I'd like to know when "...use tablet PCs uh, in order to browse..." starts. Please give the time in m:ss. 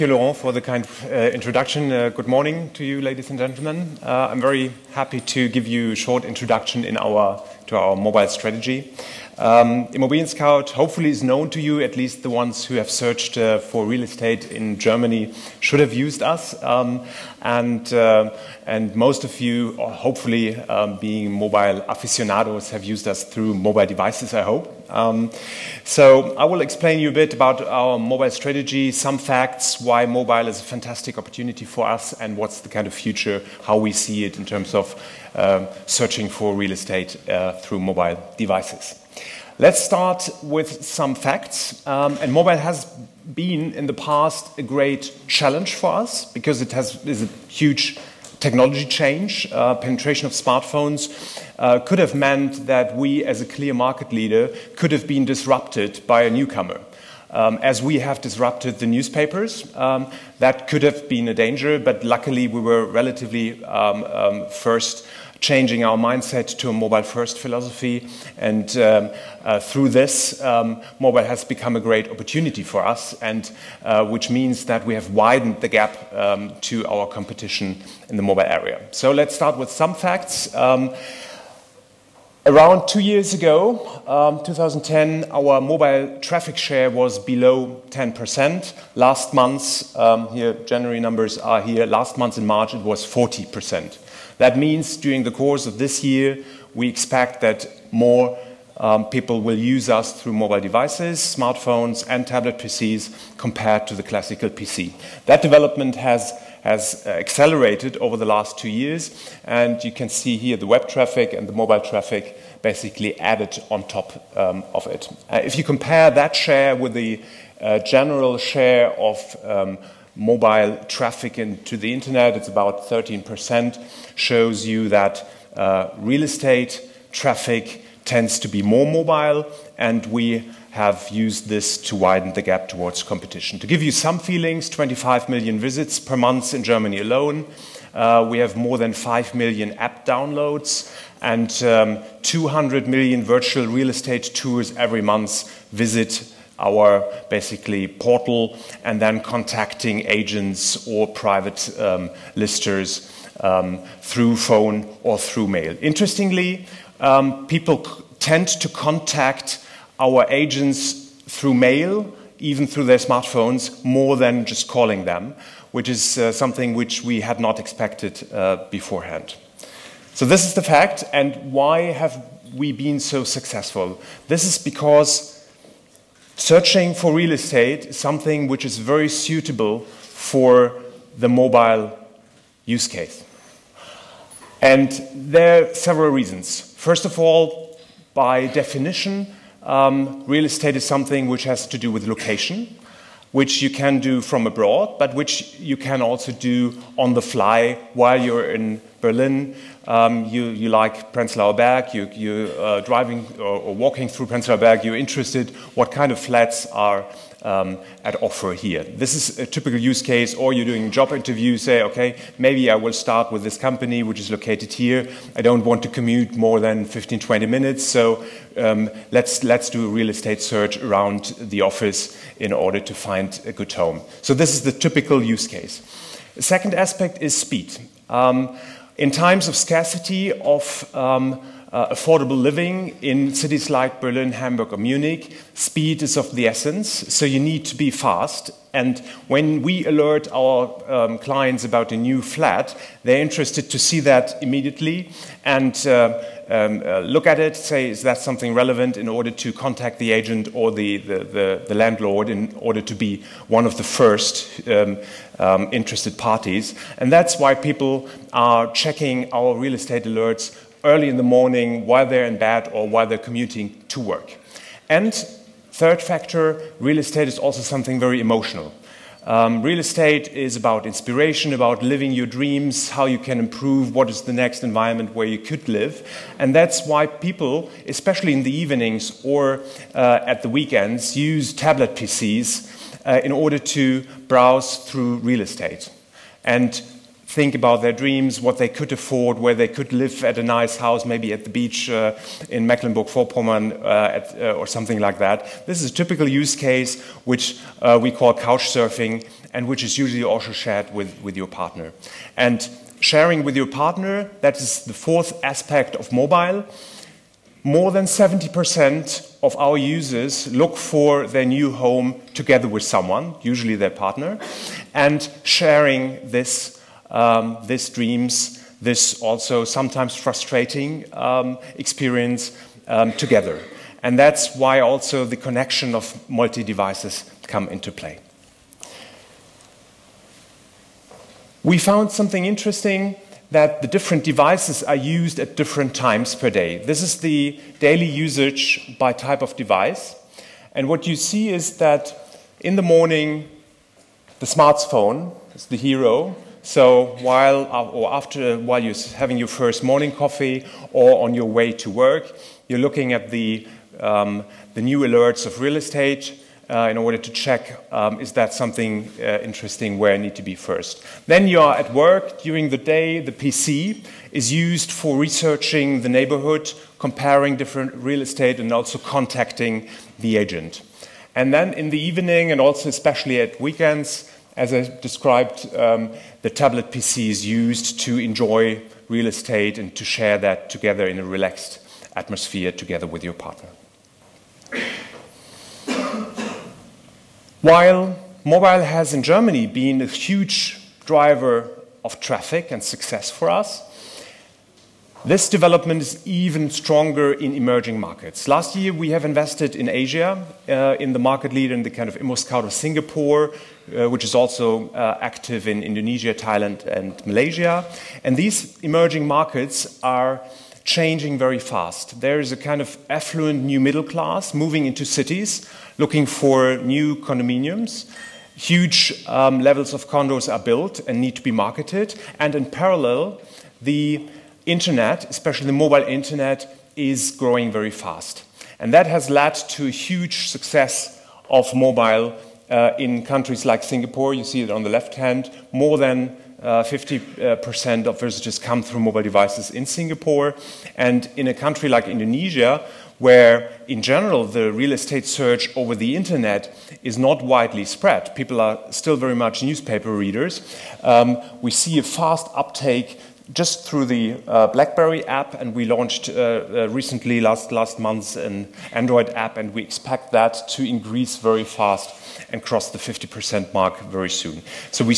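4:41.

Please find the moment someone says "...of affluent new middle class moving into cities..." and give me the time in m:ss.
6:52.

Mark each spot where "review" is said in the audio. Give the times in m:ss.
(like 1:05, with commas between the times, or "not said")
not said.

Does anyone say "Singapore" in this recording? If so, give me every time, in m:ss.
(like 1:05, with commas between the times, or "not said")
6:42, 7:13, 7:19.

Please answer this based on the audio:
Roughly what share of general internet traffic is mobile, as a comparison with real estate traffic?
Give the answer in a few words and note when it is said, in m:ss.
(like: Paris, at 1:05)
13%, at 2:02.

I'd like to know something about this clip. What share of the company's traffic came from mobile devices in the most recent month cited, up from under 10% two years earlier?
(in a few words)
40%.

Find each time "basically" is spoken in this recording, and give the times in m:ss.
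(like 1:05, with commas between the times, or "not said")
1:52, 2:27.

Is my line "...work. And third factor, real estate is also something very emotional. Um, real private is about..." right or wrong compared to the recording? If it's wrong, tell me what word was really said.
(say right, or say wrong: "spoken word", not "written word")
wrong: "estate", not "private".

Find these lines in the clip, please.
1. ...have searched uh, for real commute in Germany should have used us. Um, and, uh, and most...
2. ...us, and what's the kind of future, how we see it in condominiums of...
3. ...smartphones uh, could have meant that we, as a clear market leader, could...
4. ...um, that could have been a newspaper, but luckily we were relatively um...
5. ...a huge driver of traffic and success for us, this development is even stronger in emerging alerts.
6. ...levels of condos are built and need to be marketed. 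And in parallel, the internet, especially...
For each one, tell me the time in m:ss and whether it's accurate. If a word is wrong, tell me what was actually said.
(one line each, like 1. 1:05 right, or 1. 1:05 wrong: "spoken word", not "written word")
1. 0:12 wrong: "estate", not "commute"
2. 0:31 wrong: "terms", not "condominiums"
3. 0:50 right
4. 0:59 wrong: "danger", not "newspaper"
5. 6:30 wrong: "markets", not "alerts"
6. 6:59 right.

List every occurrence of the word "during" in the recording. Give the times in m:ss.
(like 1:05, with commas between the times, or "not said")
1:34, 6:02.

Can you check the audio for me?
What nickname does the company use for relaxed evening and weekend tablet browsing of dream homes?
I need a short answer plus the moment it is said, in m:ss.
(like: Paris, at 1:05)
couch surfing, at 4:58.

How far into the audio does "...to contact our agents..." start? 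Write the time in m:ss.
2:38.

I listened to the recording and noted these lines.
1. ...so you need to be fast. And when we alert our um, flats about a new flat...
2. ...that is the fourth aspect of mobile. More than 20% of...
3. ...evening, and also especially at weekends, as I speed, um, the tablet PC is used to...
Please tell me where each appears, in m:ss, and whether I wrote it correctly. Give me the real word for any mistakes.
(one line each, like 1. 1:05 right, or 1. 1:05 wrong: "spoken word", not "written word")
1. 3:57 wrong: "clients", not "flats"
2. 5:04 wrong: "70", not "20"
3. 6:12 wrong: "described", not "speed".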